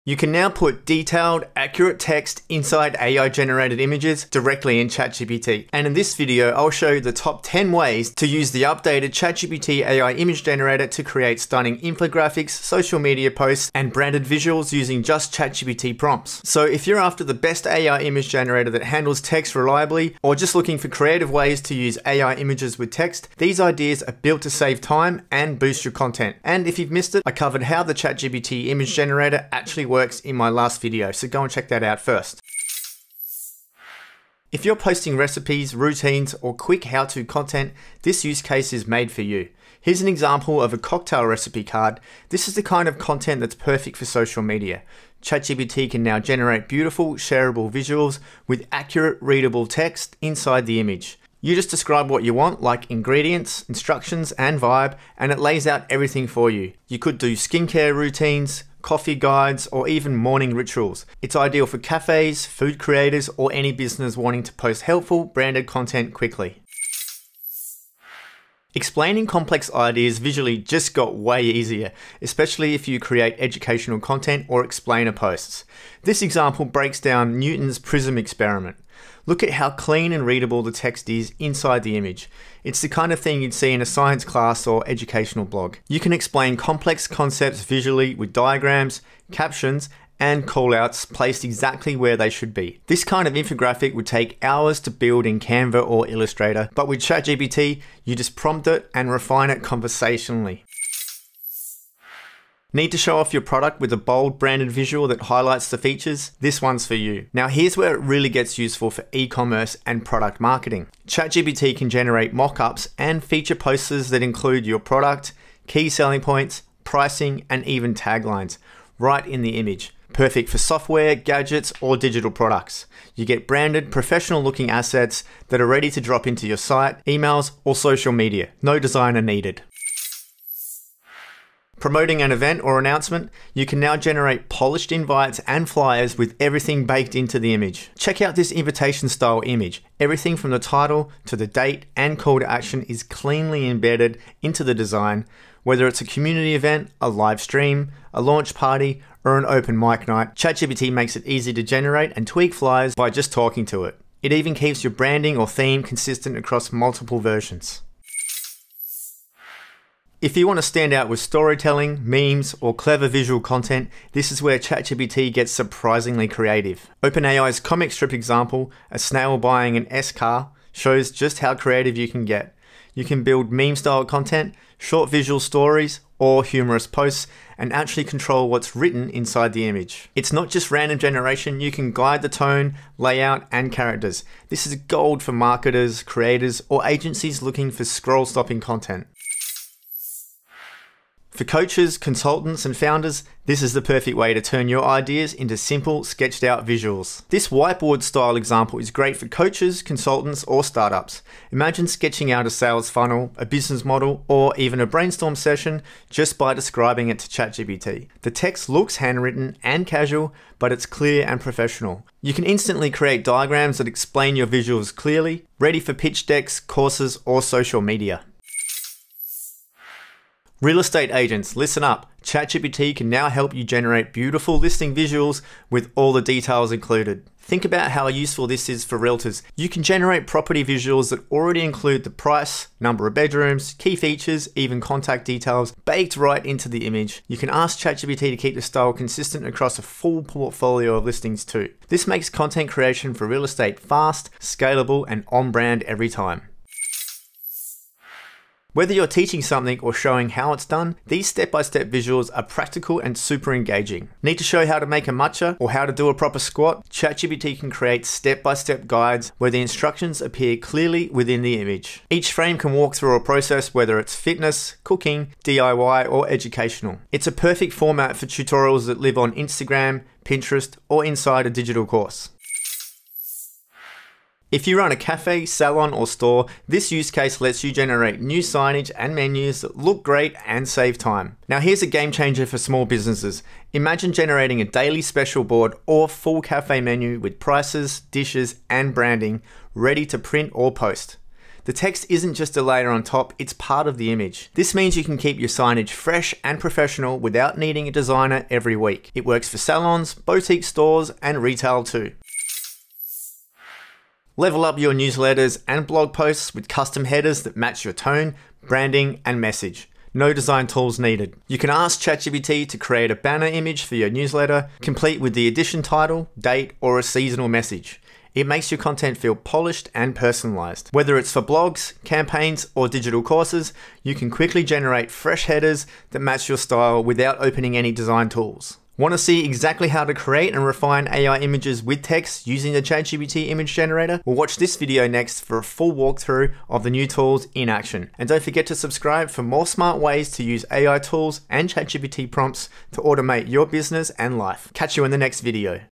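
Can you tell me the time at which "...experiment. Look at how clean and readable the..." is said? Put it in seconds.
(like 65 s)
78 s.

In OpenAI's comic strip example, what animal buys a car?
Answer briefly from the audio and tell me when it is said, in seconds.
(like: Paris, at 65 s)
A snail, at 168 s.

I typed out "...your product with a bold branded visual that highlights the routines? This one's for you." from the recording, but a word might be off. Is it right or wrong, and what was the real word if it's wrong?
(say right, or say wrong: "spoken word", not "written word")
wrong: "features", not "routines".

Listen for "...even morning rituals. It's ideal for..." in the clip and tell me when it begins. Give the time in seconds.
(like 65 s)
59 s.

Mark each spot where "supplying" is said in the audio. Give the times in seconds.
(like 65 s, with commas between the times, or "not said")
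not said.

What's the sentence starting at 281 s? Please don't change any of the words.
Now here's a game changer for small businesses.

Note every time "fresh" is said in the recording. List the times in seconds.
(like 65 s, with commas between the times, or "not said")
295 s, 325 s.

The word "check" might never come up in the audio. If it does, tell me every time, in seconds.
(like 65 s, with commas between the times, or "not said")
31 s, 137 s.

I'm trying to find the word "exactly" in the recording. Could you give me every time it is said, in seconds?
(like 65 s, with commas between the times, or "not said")
91 s, 329 s.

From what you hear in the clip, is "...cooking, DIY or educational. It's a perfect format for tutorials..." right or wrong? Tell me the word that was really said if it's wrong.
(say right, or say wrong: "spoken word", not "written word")
right.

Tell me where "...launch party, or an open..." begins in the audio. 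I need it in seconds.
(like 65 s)
148 s.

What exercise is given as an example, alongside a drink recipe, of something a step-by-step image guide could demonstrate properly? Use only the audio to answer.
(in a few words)
Squat.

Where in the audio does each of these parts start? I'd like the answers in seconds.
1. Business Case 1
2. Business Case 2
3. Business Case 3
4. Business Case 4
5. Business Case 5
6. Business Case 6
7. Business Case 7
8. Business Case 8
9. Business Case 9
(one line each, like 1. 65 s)
1. 33 s
2. 67 s
3. 101 s
4. 130 s
5. 158 s
6. 190 s
7. 219 s
8. 247 s
9. 273 s.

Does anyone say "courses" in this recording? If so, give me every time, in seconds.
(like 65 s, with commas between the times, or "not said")
216 s, 271 s, 323 s.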